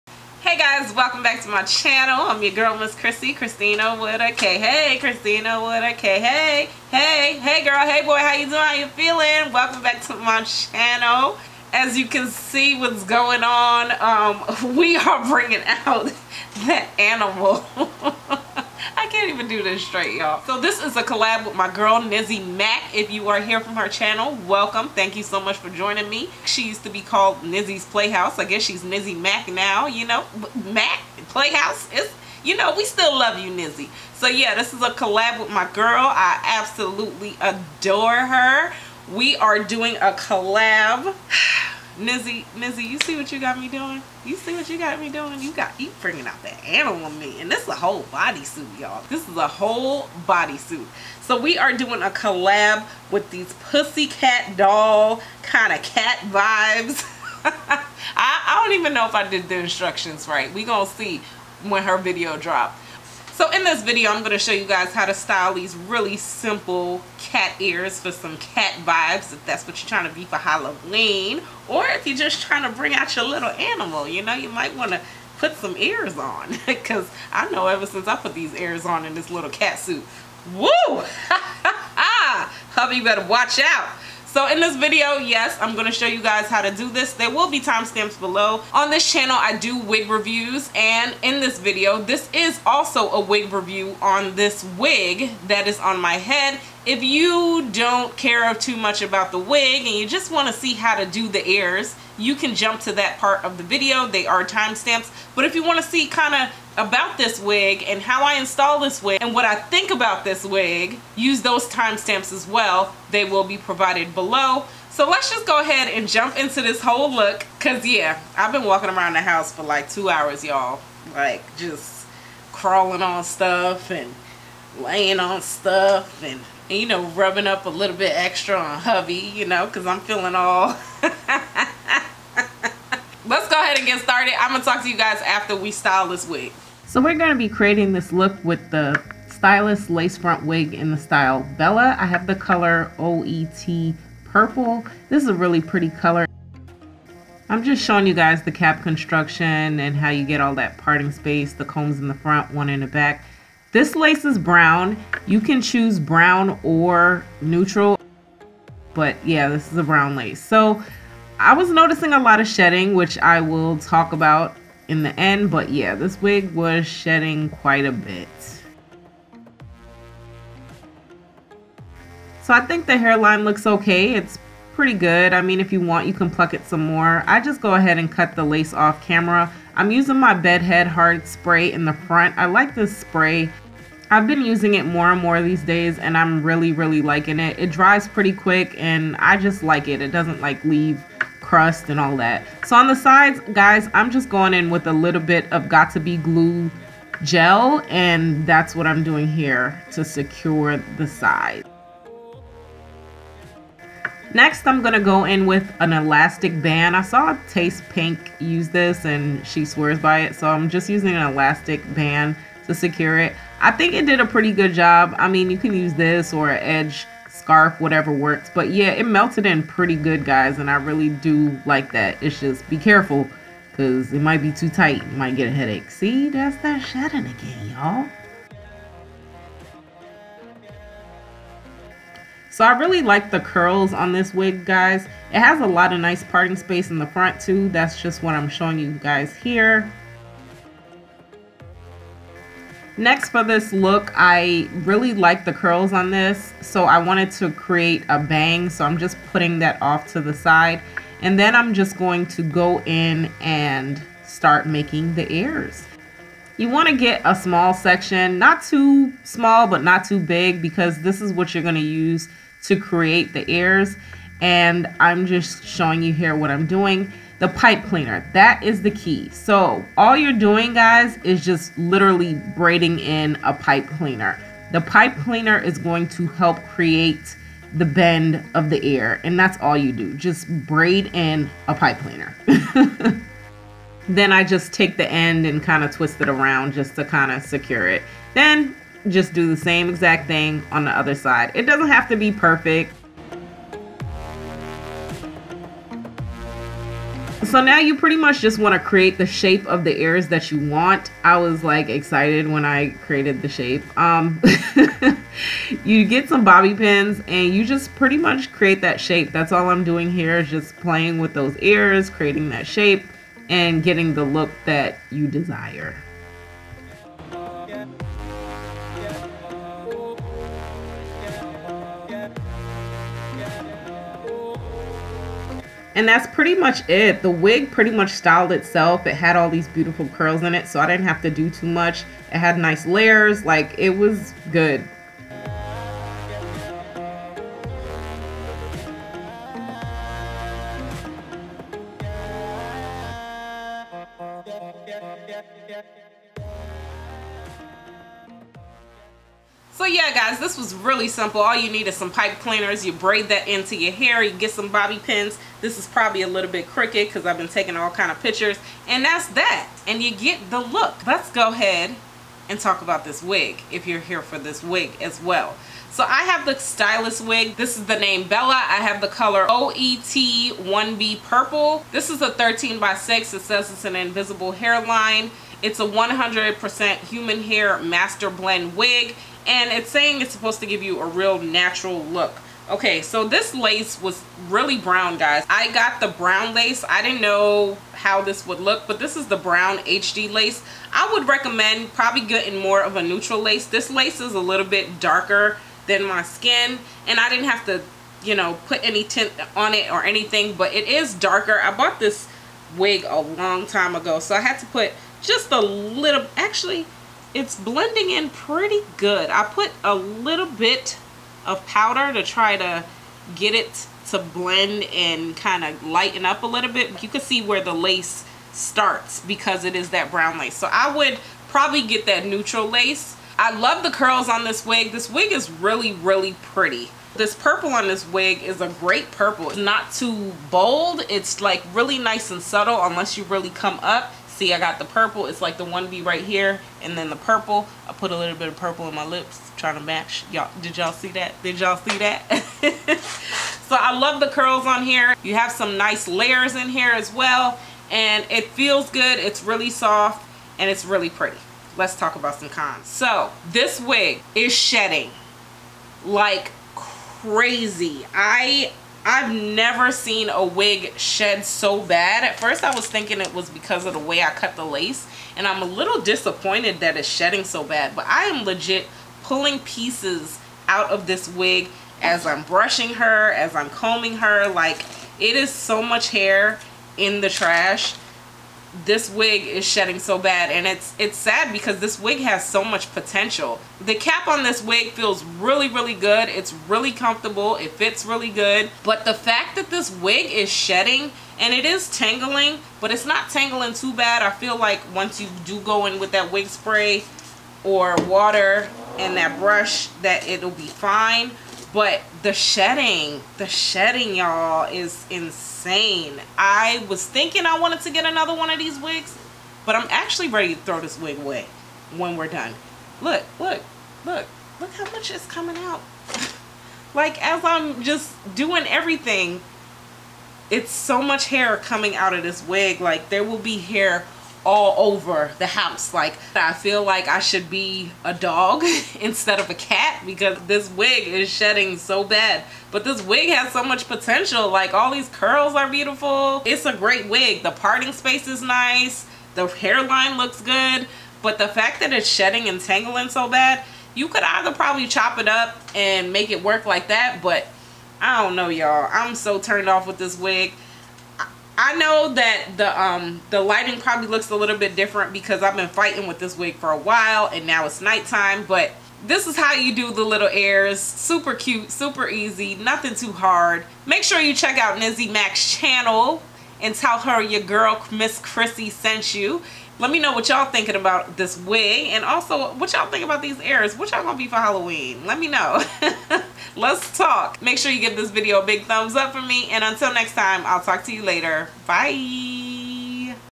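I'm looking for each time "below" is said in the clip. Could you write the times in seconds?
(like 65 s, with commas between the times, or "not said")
88 s, 114 s.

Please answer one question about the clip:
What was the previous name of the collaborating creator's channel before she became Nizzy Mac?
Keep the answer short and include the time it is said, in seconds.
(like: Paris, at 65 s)
Nizzy's Playhouse, at 27 s.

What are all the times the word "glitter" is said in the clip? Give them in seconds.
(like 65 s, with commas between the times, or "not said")
not said.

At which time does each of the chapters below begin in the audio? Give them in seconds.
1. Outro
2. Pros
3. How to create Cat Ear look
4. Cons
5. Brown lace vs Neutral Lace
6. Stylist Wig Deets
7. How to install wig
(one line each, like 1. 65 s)
1. 558 s
2. 424 s
3. 243 s
4. 452 s
5. 383 s
6. 362 s
7. 138 s.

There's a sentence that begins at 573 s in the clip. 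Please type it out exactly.
What y'all gonna be for Halloween?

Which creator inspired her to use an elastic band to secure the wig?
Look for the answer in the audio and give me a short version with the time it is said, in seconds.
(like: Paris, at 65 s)
Taste Pink, at 207 s.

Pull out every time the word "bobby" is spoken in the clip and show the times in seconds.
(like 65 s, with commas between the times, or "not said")
306 s, 354 s.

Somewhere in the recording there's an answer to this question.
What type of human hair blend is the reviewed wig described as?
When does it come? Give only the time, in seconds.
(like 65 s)
377 s.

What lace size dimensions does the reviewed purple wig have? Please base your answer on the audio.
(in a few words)
13 by 6.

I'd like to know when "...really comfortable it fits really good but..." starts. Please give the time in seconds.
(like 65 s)
486 s.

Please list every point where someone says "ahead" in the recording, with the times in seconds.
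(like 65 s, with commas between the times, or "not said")
115 s, 133 s, 177 s, 361 s.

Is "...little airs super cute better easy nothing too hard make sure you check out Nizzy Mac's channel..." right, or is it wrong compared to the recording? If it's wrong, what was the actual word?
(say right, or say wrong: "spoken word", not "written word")
wrong: "super", not "better".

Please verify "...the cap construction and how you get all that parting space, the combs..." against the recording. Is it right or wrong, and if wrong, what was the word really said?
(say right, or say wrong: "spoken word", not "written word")
right.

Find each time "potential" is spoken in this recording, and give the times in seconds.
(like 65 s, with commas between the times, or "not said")
482 s, 533 s.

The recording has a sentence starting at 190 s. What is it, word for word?
It doesn't like leave crust and all that.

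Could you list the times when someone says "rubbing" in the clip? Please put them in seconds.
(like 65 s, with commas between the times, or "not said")
127 s.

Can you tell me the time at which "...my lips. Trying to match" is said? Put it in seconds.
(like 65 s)
438 s.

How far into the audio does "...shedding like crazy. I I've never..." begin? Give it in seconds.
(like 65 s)
454 s.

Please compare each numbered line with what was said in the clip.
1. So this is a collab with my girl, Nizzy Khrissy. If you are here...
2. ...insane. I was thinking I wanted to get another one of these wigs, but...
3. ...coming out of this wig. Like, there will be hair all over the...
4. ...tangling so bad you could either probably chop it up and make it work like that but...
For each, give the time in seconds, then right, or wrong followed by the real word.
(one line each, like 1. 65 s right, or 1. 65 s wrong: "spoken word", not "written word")
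1. 20 s wrong: "Mac", not "Khrissy"
2. 505 s right
3. 521 s right
4. 542 s right.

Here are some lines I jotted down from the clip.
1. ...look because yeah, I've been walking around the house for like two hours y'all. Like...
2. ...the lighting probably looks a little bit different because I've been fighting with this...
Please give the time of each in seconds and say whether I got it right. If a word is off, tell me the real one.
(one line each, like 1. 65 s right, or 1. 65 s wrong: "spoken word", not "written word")
1. 117 s right
2. 553 s right.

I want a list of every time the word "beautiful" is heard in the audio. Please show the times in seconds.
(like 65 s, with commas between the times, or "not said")
329 s, 535 s.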